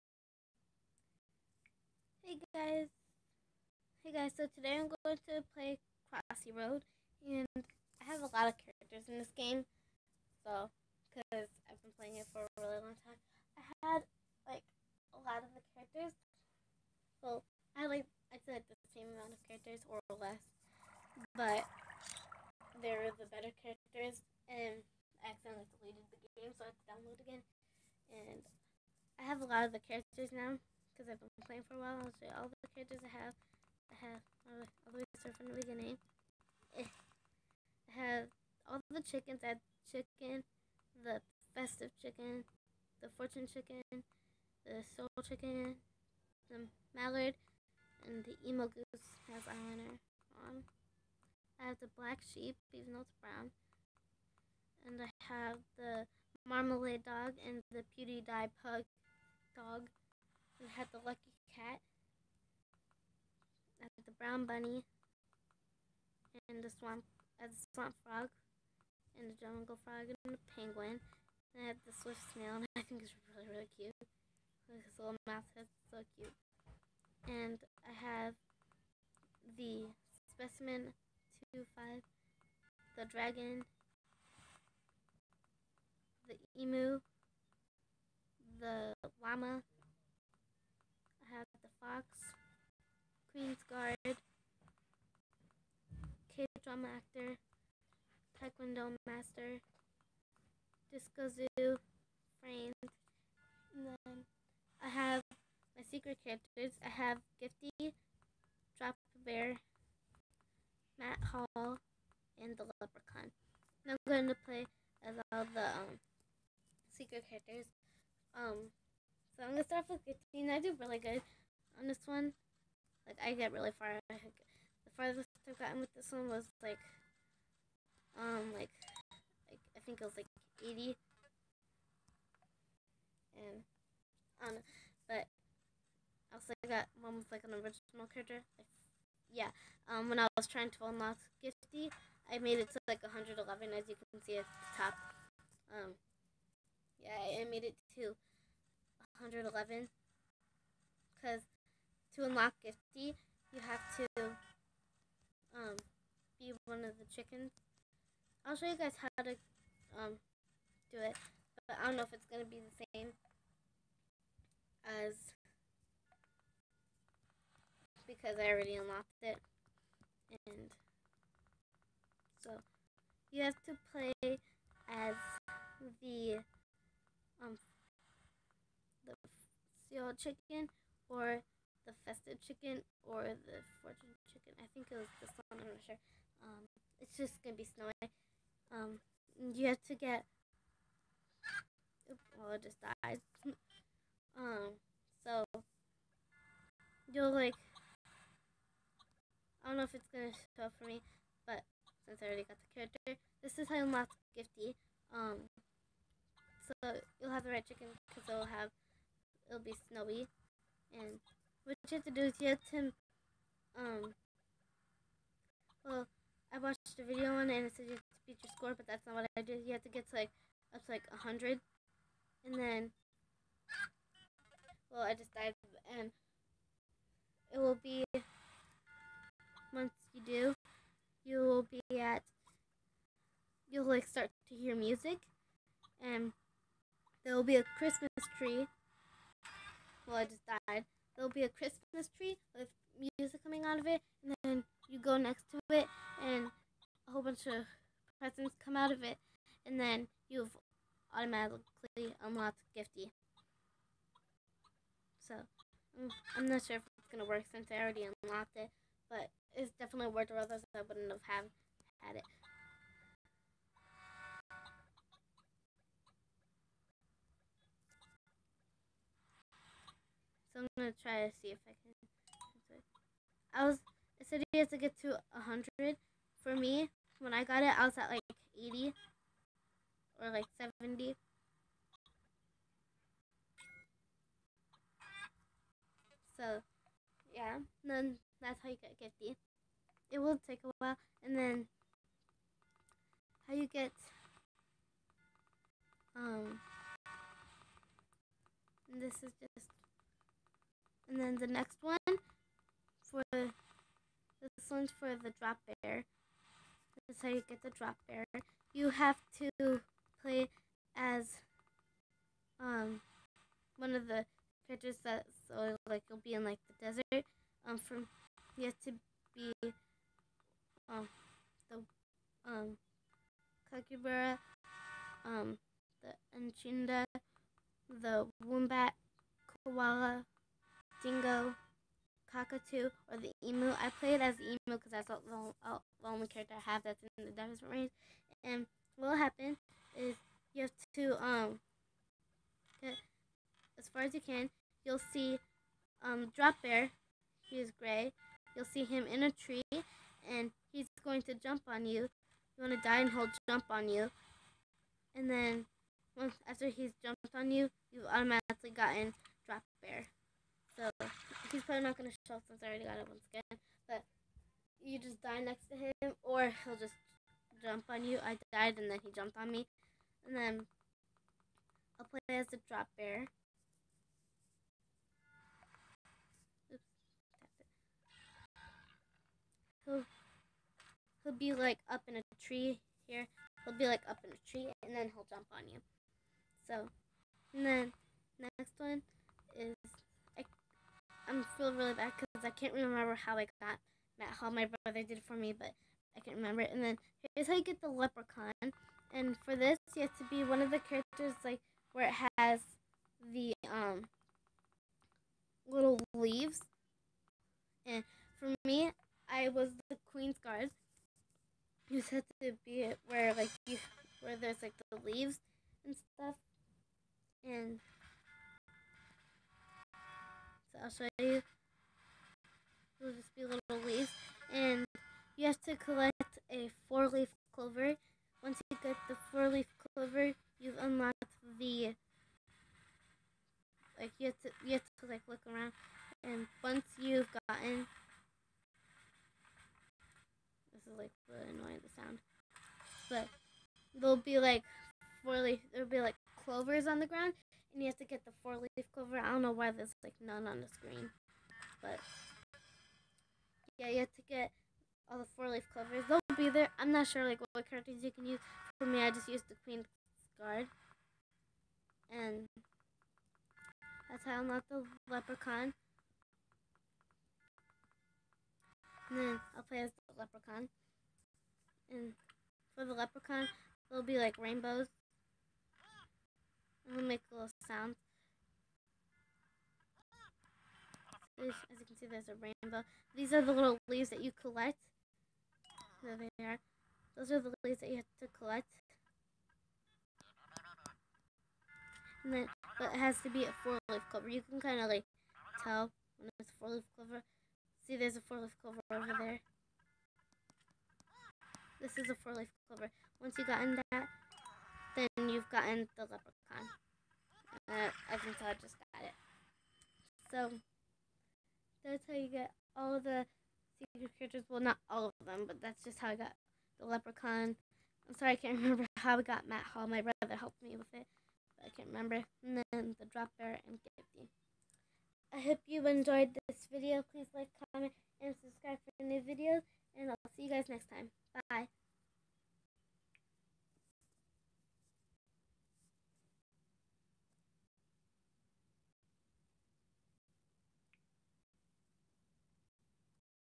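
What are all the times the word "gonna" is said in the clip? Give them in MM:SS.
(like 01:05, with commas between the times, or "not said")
01:59, 03:07, 03:20, 04:17, 04:30, 06:01.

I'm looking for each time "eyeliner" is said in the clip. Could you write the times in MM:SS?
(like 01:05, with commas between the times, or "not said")
00:49.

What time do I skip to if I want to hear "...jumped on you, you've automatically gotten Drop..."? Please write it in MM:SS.
05:57.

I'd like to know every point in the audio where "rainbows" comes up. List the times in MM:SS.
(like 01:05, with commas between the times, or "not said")
07:54, 08:02.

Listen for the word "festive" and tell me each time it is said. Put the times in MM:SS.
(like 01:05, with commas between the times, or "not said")
00:41, 03:02.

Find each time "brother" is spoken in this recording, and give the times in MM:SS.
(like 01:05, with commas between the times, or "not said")
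06:34, 08:40.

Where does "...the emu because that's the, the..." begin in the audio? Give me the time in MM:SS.
05:34.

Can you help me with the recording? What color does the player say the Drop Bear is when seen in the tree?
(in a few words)
Gray.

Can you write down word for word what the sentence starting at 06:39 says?
And for this, you have to be one of the characters like where it has the um little leaves.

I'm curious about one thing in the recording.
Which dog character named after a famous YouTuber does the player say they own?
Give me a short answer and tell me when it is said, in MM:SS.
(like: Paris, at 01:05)
PewDiePie pug, at 00:57.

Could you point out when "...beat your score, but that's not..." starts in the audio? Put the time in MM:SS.
03:38.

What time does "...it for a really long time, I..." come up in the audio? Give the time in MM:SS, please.
00:12.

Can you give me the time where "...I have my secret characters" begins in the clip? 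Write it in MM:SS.
01:44.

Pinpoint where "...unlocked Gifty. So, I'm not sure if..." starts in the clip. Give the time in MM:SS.
04:12.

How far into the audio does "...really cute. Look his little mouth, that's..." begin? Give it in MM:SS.
01:13.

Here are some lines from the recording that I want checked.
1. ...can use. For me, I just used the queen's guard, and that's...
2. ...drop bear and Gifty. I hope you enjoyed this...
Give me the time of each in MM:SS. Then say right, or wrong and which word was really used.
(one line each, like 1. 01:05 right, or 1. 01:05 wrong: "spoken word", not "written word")
1. 07:38 right
2. 08:43 right.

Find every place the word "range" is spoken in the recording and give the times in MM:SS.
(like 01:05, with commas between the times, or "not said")
05:37.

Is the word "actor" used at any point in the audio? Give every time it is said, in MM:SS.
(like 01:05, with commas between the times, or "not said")
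01:36.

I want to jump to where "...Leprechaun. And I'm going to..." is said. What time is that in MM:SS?
01:52.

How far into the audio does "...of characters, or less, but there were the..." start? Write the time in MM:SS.
00:19.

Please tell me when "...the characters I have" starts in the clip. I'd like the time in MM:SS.
00:32.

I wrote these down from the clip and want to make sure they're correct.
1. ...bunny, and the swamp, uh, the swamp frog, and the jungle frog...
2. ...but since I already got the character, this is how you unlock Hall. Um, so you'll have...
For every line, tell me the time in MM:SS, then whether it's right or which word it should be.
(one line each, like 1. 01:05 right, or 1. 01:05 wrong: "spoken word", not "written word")
1. 01:04 right
2. 03:21 wrong: "Gifty", not "Hall".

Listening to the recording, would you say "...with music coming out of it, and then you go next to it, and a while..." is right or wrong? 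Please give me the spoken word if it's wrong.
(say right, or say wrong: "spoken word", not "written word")
wrong: "whole", not "while".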